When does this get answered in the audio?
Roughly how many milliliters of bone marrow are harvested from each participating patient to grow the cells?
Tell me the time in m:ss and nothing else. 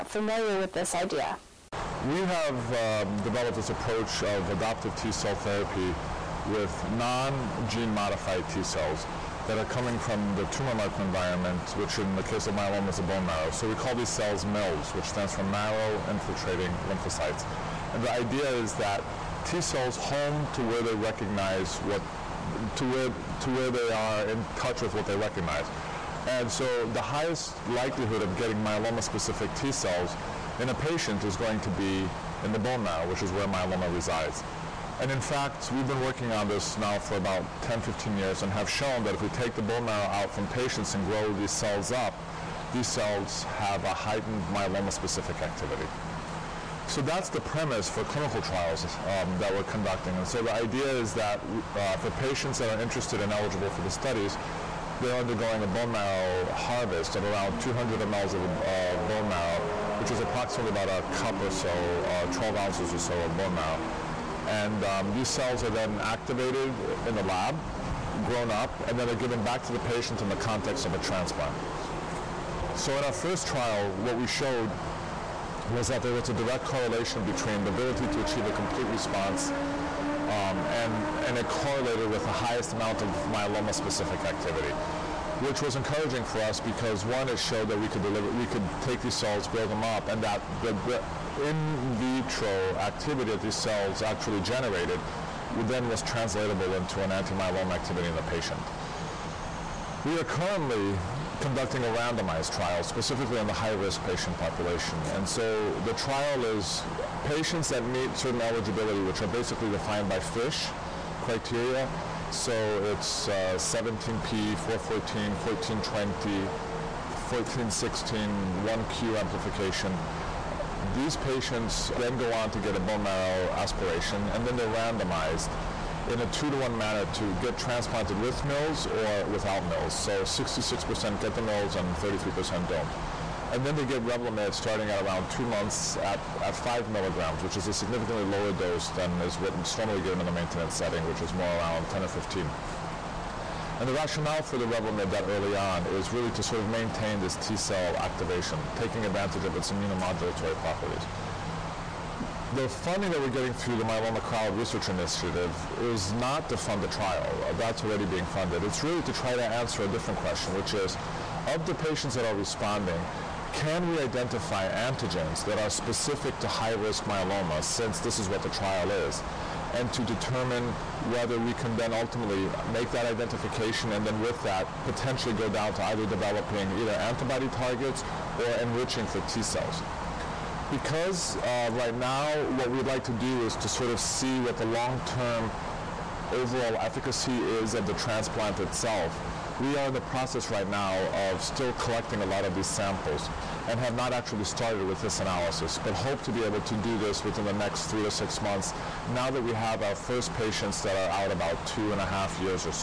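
0:57.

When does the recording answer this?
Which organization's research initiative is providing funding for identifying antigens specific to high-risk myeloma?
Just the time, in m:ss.
2:33.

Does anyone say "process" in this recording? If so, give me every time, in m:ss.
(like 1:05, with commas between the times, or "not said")
3:10.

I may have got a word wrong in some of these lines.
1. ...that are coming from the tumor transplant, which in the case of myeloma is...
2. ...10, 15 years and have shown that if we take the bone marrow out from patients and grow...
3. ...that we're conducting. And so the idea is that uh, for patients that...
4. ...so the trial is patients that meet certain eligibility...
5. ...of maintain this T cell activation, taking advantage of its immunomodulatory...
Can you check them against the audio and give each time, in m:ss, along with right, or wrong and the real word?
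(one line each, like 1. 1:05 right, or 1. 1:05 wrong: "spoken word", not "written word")
1. 0:09 wrong: "microenvironment", not "transplant"
2. 0:37 right
3. 0:49 right
4. 1:45 right
5. 2:26 right.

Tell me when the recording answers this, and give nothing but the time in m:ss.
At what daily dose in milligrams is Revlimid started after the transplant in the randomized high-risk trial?
2:16.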